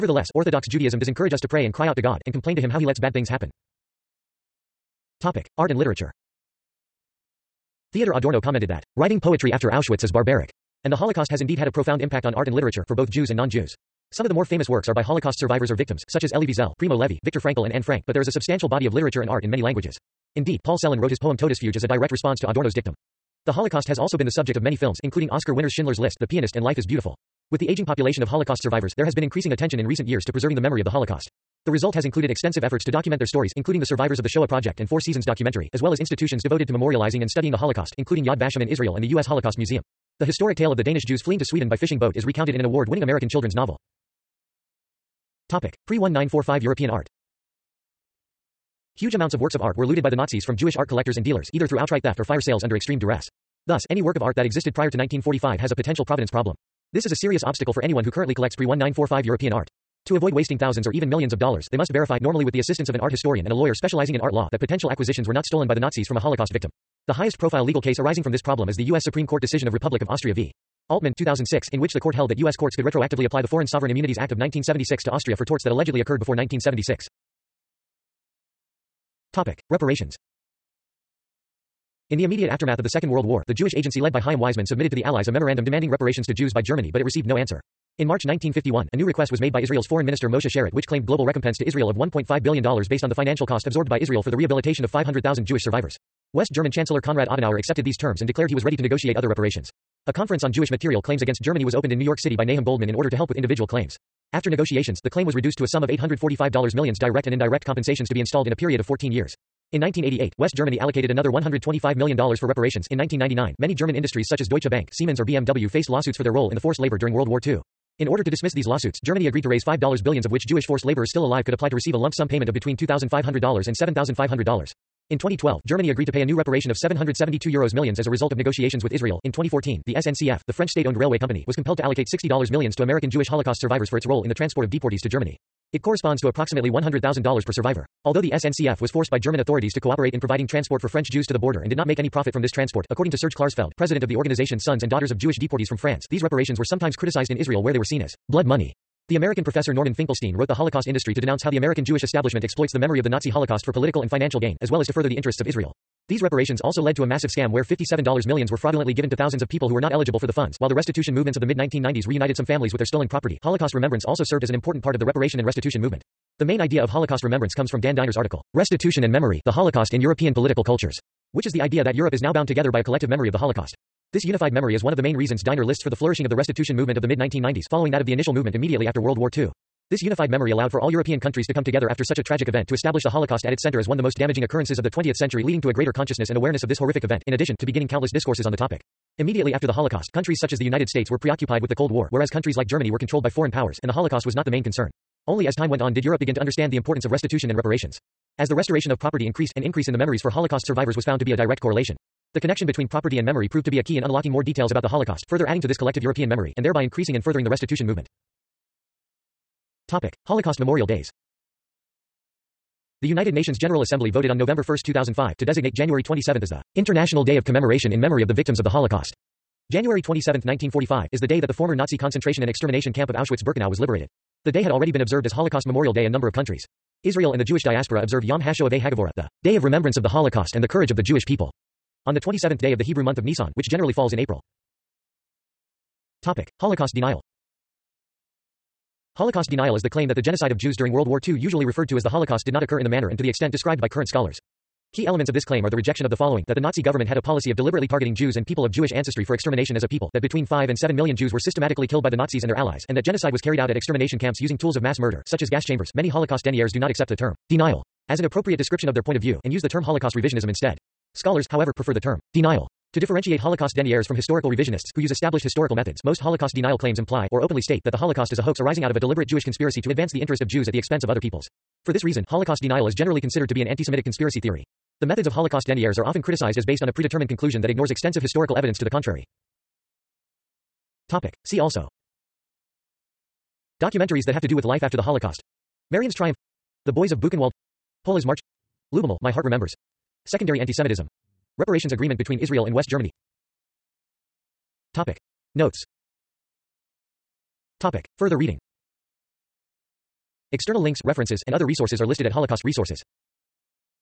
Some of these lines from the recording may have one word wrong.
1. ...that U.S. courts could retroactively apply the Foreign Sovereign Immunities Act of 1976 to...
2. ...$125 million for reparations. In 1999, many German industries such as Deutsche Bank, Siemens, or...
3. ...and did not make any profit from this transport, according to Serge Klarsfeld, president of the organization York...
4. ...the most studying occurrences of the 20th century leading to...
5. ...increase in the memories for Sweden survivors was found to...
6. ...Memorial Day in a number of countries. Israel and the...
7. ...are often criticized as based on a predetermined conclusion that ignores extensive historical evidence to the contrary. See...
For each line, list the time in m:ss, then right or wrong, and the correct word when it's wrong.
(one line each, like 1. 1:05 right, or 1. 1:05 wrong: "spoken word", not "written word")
1. 1:12 right
2. 1:51 right
3. 2:21 wrong: "Sons", not "York"
4. 3:03 wrong: "damaging", not "studying"
5. 3:19 wrong: "Holocaust", not "Sweden"
6. 3:45 right
7. 4:35 right.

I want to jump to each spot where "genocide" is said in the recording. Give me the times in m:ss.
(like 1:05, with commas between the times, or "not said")
4:00, 4:13.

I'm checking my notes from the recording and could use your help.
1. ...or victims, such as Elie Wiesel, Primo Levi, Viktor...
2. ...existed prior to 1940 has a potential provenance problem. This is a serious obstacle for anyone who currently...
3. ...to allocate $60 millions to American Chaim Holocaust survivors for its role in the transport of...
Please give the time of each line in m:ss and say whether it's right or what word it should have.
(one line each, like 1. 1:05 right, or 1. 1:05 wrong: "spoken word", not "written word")
1. 0:15 right
2. 0:54 wrong: "1945", not "1940"
3. 2:11 wrong: "Jewish", not "Chaim".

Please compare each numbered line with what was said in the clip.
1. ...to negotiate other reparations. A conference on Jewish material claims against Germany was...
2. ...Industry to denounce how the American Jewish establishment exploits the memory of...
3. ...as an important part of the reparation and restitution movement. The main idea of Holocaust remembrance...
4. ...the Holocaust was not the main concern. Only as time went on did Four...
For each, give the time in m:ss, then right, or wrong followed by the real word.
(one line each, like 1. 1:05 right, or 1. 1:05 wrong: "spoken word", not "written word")
1. 1:38 right
2. 2:30 right
3. 2:44 right
4. 3:13 wrong: "Europe", not "Four".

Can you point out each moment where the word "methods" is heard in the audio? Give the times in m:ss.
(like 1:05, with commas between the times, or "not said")
4:25, 4:35.